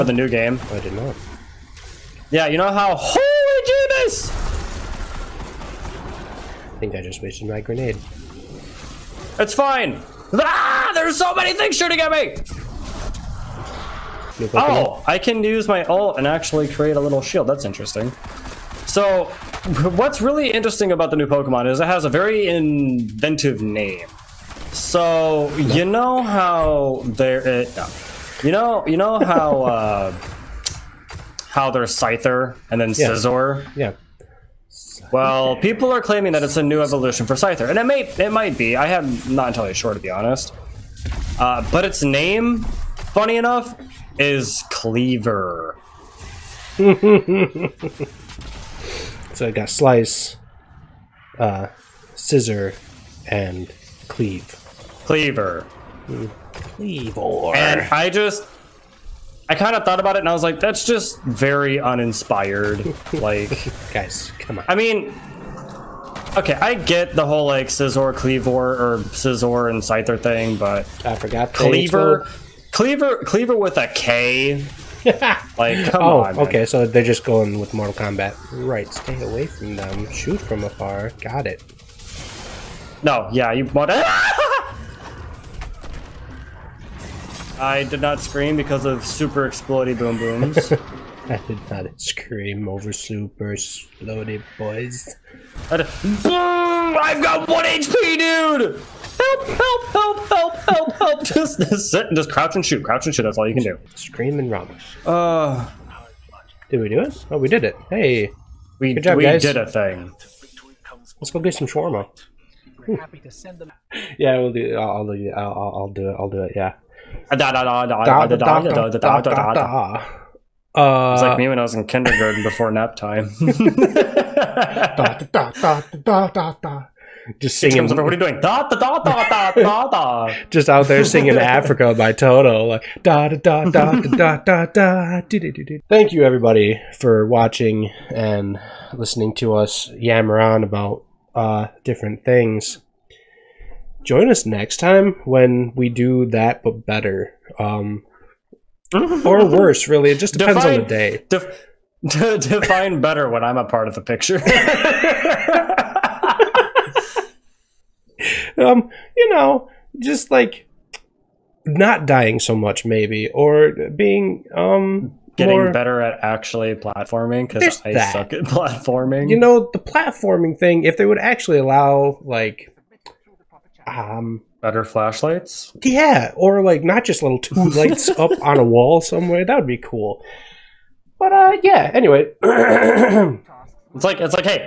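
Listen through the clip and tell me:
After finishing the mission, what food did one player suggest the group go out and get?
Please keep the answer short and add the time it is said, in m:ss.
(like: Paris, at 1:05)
Shawarma, at 1:51.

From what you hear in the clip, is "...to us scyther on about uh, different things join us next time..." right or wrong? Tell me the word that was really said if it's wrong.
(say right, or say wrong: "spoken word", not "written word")
wrong: "yammer", not "scyther".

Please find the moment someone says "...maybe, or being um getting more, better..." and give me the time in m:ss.
2:42.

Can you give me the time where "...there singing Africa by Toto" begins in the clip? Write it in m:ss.
2:10.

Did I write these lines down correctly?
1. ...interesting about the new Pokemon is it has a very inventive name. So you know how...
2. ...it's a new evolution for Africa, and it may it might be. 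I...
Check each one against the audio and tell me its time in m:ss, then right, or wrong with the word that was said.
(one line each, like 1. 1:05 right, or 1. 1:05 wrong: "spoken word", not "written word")
1. 0:20 right
2. 0:36 wrong: "Scyther", not "Africa".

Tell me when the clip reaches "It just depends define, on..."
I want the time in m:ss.
2:30.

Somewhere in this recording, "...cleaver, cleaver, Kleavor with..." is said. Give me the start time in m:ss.
1:11.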